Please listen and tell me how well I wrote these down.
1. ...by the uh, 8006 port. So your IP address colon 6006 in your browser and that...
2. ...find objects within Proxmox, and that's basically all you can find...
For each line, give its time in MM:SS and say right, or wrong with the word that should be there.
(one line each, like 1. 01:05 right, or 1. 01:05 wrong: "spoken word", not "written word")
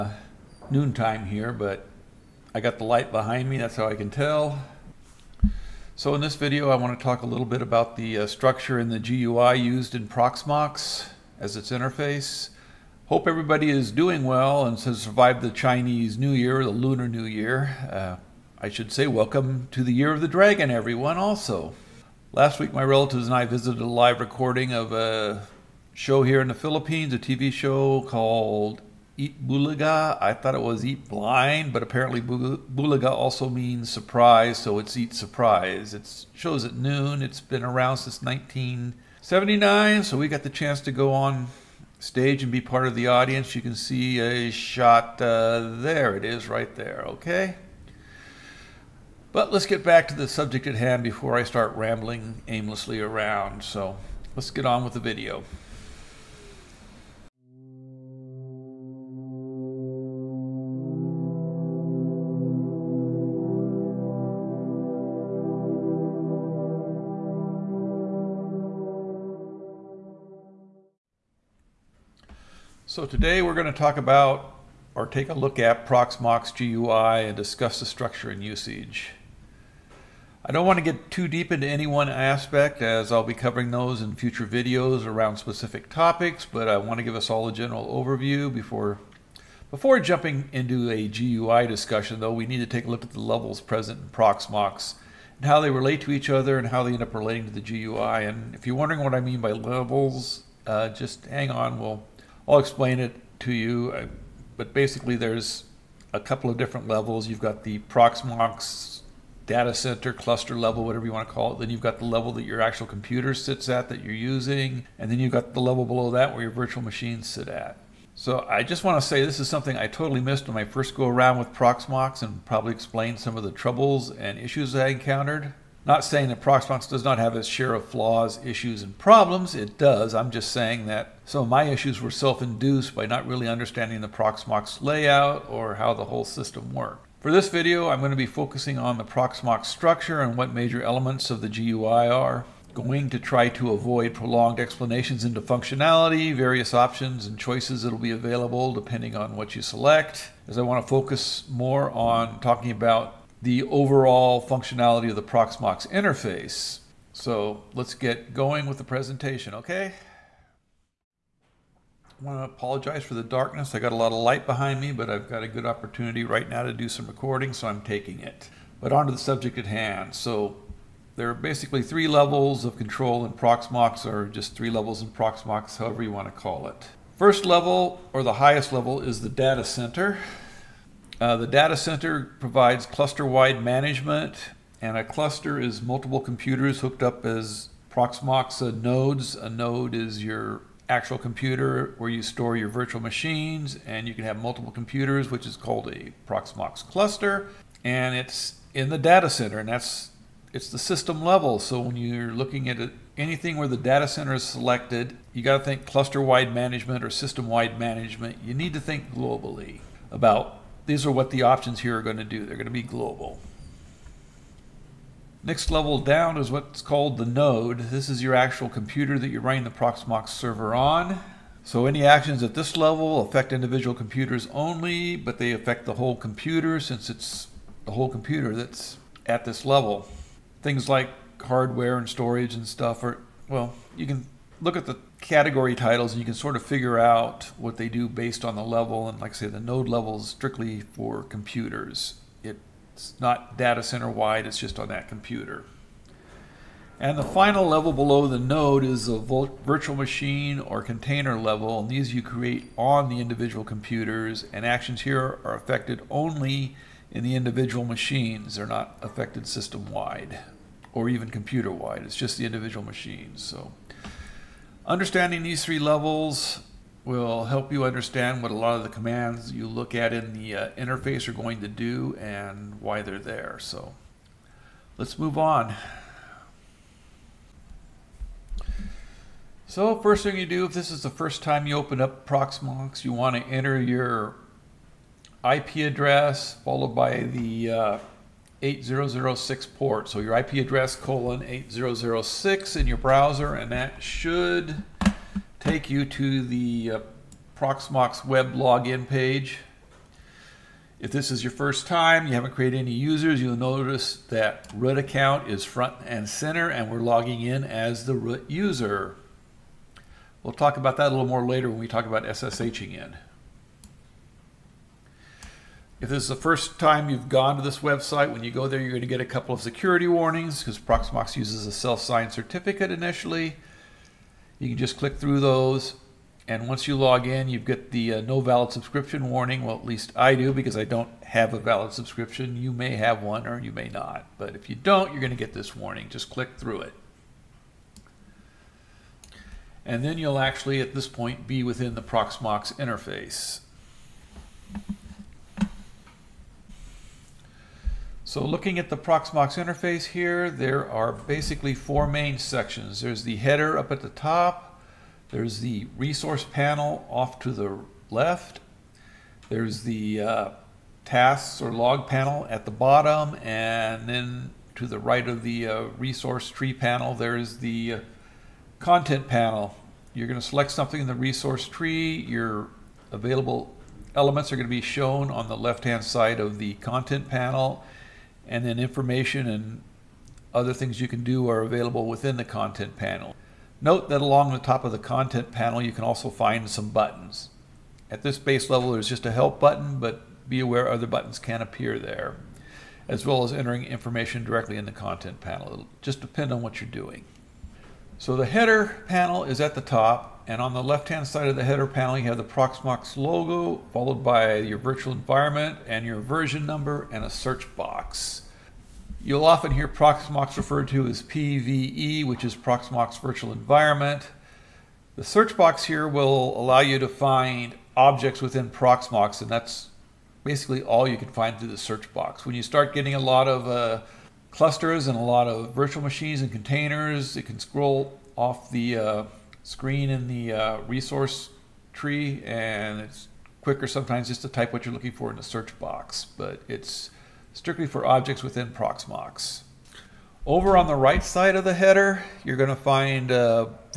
1. 04:46 wrong: "8006", not "6006"
2. 06:57 right.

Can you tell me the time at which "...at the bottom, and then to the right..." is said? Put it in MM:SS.
06:02.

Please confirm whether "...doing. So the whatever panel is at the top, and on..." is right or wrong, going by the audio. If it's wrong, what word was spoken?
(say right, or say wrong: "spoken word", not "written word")
wrong: "header", not "whatever".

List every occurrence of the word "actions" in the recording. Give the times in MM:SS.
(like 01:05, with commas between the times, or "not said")
03:42, 04:14.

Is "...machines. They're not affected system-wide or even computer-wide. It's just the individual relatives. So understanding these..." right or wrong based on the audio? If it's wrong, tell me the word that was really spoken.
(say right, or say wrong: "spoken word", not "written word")
wrong: "machines", not "relatives".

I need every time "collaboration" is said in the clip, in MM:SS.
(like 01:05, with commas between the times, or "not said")
not said.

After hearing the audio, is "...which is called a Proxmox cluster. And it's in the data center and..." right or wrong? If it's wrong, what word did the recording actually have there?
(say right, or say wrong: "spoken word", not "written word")
right.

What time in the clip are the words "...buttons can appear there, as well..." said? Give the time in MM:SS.
06:31.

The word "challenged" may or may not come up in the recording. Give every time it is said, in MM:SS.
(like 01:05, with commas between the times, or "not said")
not said.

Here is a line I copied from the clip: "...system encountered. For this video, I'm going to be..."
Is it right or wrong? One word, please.
wrong.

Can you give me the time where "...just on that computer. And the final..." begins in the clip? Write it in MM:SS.
04:04.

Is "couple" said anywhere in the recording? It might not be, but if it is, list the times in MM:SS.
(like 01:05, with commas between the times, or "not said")
01:46, 05:19.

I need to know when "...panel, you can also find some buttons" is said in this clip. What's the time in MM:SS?
06:25.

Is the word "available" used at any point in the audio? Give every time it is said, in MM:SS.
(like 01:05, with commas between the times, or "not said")
02:28, 06:13, 06:21.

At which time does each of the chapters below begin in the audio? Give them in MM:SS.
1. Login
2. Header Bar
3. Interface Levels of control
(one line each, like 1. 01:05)
1. 04:51
2. 06:36
3. 02:41.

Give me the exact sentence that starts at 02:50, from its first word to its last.
So there are basically three levels of control in Proxmox, or just three levels in Proxmox, however you want to call it.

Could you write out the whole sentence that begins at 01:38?
And if you're wondering what I mean by levels, uh, just hang on, we'll I'll explain it to you.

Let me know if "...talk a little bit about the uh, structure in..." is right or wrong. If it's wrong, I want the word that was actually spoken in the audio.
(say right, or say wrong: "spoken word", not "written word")
right.